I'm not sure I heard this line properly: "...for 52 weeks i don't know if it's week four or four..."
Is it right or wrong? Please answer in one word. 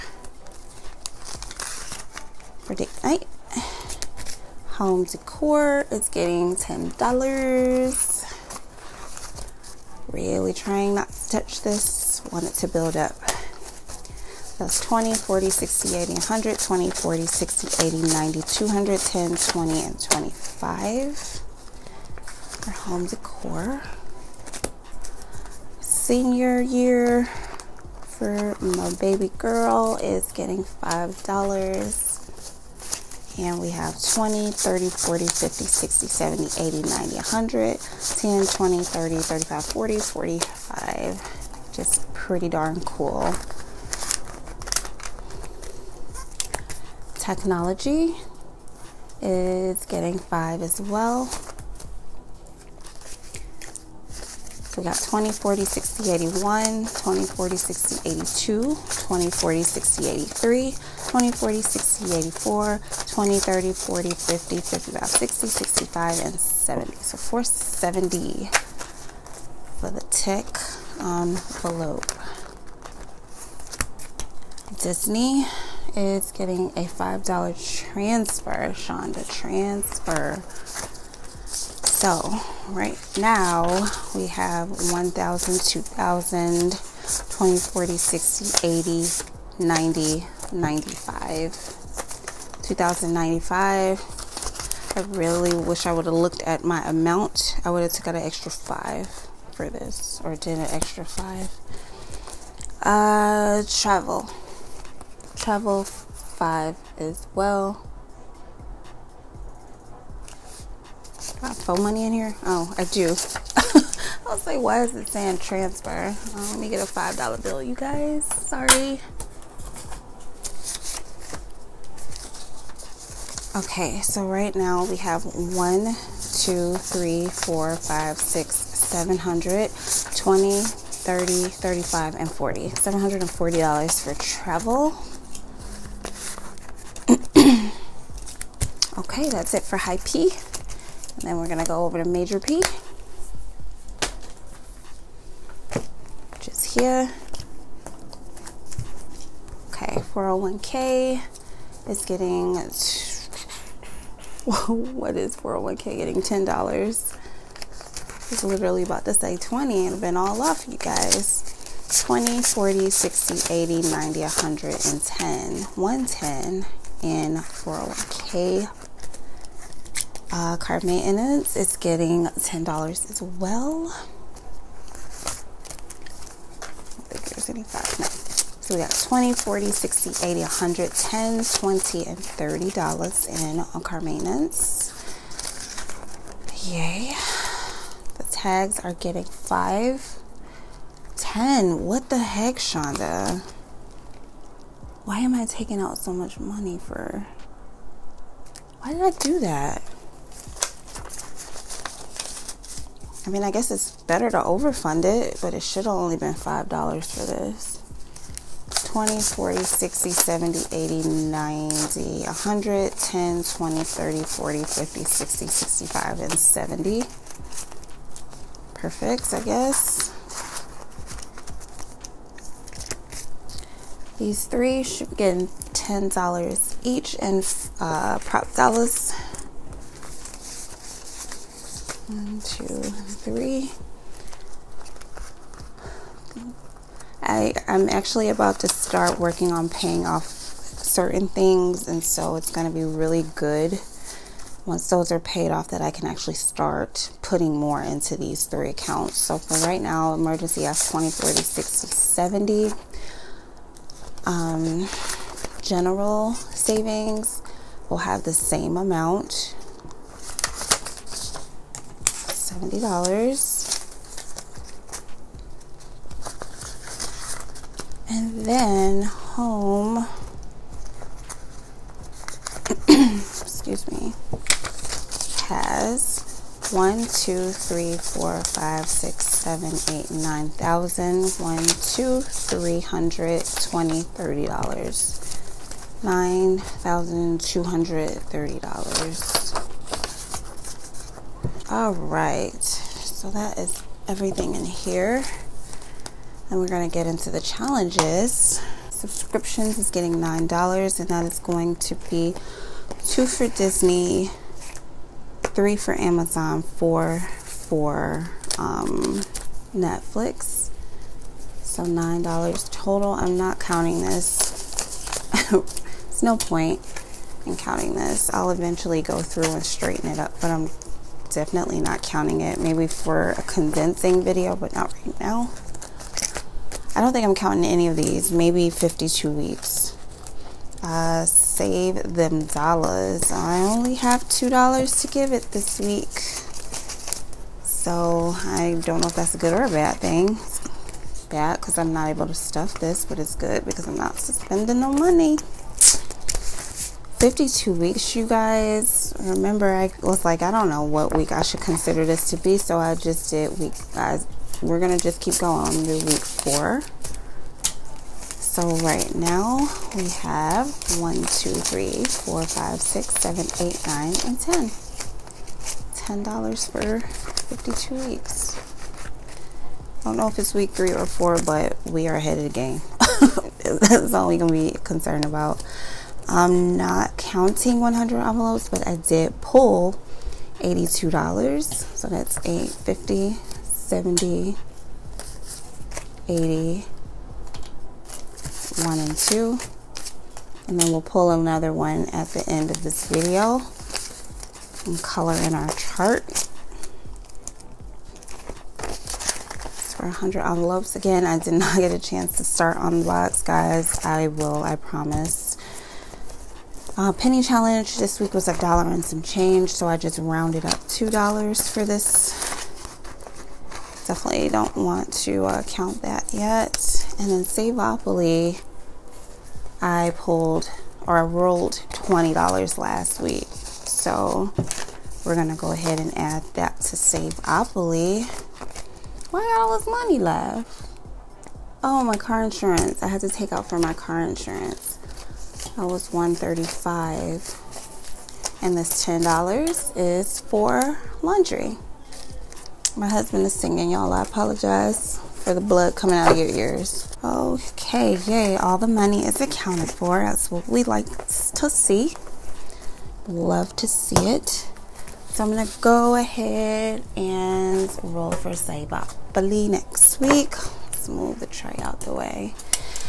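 wrong.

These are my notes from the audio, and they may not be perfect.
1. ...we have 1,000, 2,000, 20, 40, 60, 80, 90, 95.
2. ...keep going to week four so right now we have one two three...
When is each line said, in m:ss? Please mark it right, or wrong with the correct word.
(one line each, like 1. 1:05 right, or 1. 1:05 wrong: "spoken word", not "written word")
1. 1:24 right
2. 5:55 right.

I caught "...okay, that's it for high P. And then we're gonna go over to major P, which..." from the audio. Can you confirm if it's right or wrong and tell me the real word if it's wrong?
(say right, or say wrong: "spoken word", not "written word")
right.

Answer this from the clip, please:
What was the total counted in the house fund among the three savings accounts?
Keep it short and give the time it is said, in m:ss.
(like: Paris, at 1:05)
$9,230, at 4:46.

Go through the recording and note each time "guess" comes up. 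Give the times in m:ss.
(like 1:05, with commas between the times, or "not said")
3:23, 3:39.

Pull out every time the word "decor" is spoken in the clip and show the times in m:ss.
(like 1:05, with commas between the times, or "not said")
0:05, 0:23.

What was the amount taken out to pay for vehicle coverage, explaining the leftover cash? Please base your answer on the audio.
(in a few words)
$135.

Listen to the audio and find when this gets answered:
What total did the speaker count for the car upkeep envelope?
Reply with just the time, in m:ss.
3:02.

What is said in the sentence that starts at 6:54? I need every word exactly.
Definitely don't want to uh, count that yet.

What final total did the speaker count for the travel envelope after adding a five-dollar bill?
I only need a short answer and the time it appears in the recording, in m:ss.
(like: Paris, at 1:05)
$740, at 2:12.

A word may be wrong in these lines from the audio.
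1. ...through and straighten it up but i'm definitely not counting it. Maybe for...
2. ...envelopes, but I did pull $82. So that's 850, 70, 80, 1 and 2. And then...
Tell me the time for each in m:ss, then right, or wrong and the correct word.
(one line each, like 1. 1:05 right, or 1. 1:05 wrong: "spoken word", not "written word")
1. 5:19 right
2. 6:18 right.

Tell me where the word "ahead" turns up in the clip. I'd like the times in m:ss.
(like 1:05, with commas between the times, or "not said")
6:12, 7:05, 7:36.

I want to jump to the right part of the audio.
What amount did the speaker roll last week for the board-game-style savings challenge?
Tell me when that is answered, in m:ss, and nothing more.
7:01.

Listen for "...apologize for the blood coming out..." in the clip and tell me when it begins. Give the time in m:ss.
7:24.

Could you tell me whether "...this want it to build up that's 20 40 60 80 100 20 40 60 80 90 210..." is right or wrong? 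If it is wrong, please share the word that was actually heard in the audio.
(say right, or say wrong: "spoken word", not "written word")
right.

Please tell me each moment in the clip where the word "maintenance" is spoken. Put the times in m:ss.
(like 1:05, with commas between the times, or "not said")
2:50, 3:04.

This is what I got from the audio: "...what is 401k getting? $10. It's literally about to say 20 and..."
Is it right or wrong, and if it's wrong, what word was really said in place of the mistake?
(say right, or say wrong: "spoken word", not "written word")
right.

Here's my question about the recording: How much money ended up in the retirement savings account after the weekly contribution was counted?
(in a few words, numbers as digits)
$110.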